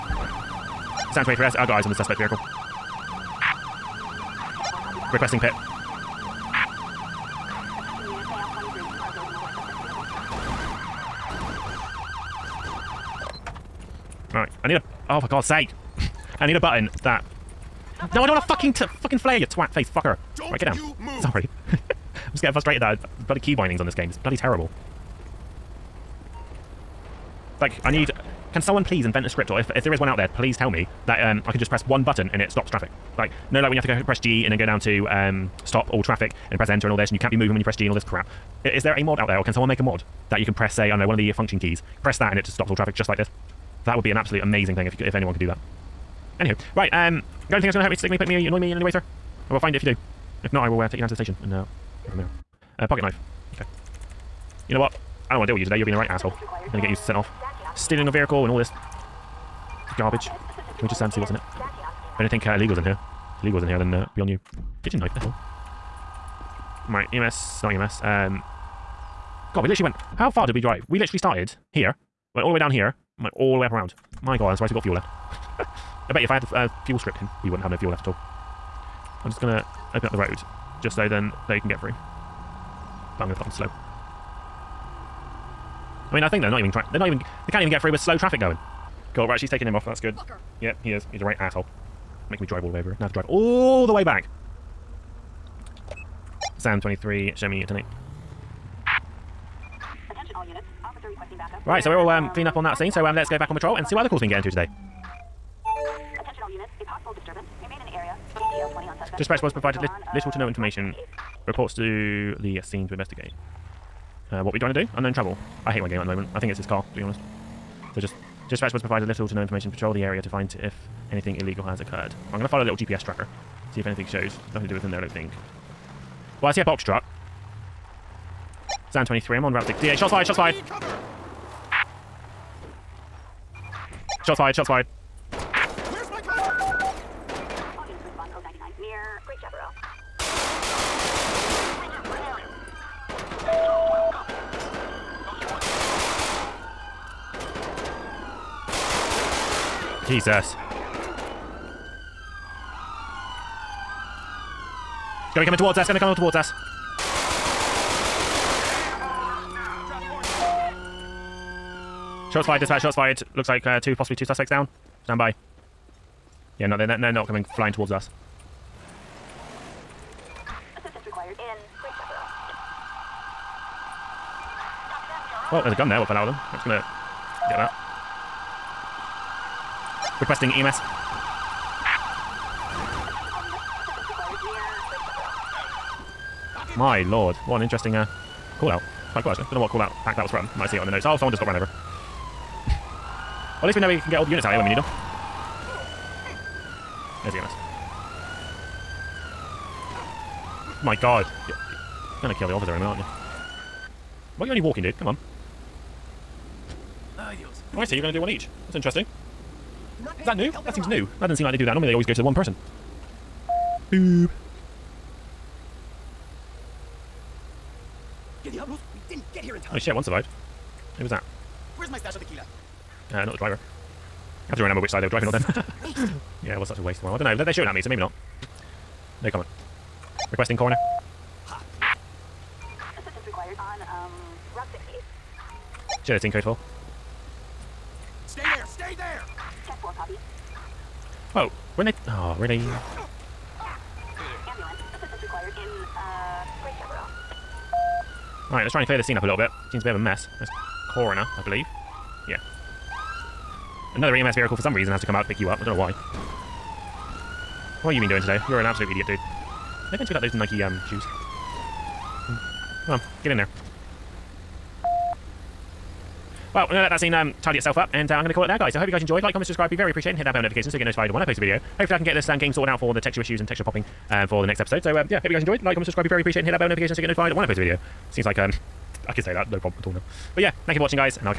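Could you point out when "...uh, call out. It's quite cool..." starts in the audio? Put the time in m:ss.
3:07.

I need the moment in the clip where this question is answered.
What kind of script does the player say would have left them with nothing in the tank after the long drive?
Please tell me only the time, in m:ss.
1:16.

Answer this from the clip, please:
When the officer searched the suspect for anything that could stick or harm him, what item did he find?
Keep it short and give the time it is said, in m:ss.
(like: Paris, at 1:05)
Pocket knife, at 0:52.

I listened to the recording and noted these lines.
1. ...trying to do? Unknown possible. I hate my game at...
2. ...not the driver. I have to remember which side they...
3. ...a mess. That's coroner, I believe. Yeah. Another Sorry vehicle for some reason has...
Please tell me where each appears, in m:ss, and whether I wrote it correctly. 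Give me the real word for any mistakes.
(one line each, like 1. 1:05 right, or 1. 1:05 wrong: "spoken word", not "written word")
1. 1:54 wrong: "trouble", not "possible"
2. 3:43 right
3. 4:09 wrong: "EMS", not "Sorry".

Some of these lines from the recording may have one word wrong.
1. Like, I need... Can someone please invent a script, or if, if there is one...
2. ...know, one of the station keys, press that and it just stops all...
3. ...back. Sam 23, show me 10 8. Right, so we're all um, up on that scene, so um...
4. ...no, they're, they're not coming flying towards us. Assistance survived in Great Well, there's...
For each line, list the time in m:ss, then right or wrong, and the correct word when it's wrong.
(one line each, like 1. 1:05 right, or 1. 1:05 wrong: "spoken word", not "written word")
1. 0:27 right
2. 0:40 wrong: "function", not "station"
3. 1:34 right
4. 2:46 wrong: "required", not "survived".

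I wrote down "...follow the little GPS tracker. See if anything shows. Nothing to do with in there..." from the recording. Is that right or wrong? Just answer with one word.
right.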